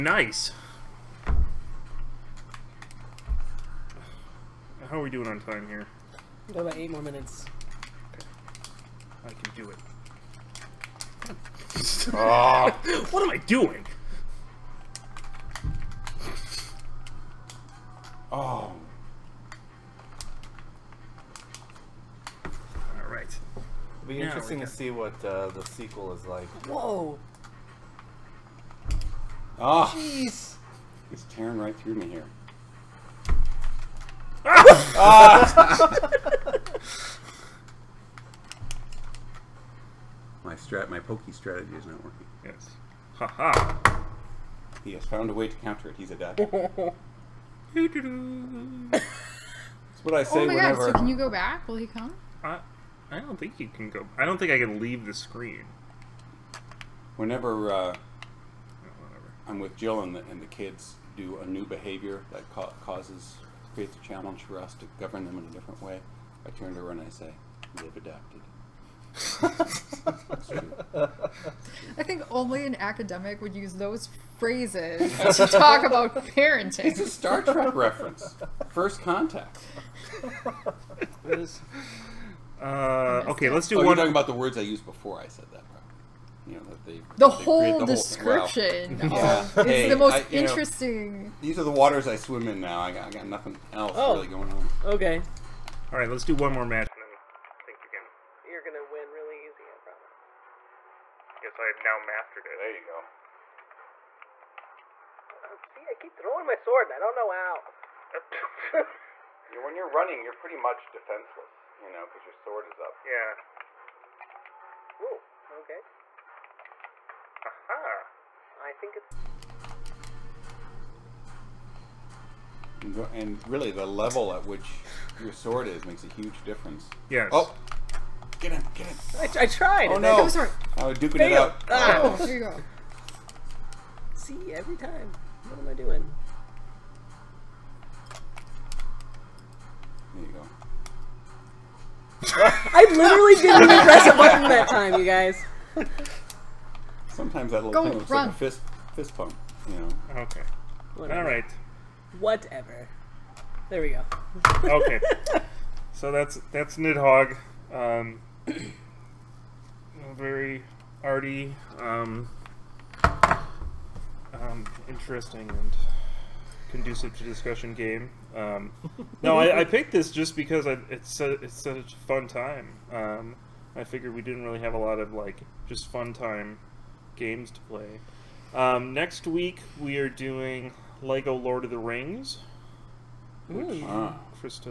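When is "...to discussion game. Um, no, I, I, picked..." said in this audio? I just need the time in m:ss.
2:47.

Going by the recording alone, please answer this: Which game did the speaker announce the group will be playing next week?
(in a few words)
Lego Lord of the Rings.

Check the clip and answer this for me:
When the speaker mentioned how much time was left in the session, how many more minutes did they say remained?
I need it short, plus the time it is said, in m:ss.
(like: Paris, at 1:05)
8, at 0:06.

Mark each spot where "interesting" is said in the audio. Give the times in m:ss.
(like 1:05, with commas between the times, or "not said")
0:24, 1:30, 2:44.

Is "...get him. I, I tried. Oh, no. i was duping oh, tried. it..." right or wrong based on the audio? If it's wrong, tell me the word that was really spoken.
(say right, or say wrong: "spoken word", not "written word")
wrong: "failed", not "tried".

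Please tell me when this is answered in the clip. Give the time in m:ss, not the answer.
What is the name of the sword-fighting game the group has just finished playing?
2:36.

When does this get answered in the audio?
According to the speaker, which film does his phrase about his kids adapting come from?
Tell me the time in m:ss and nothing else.
1:18.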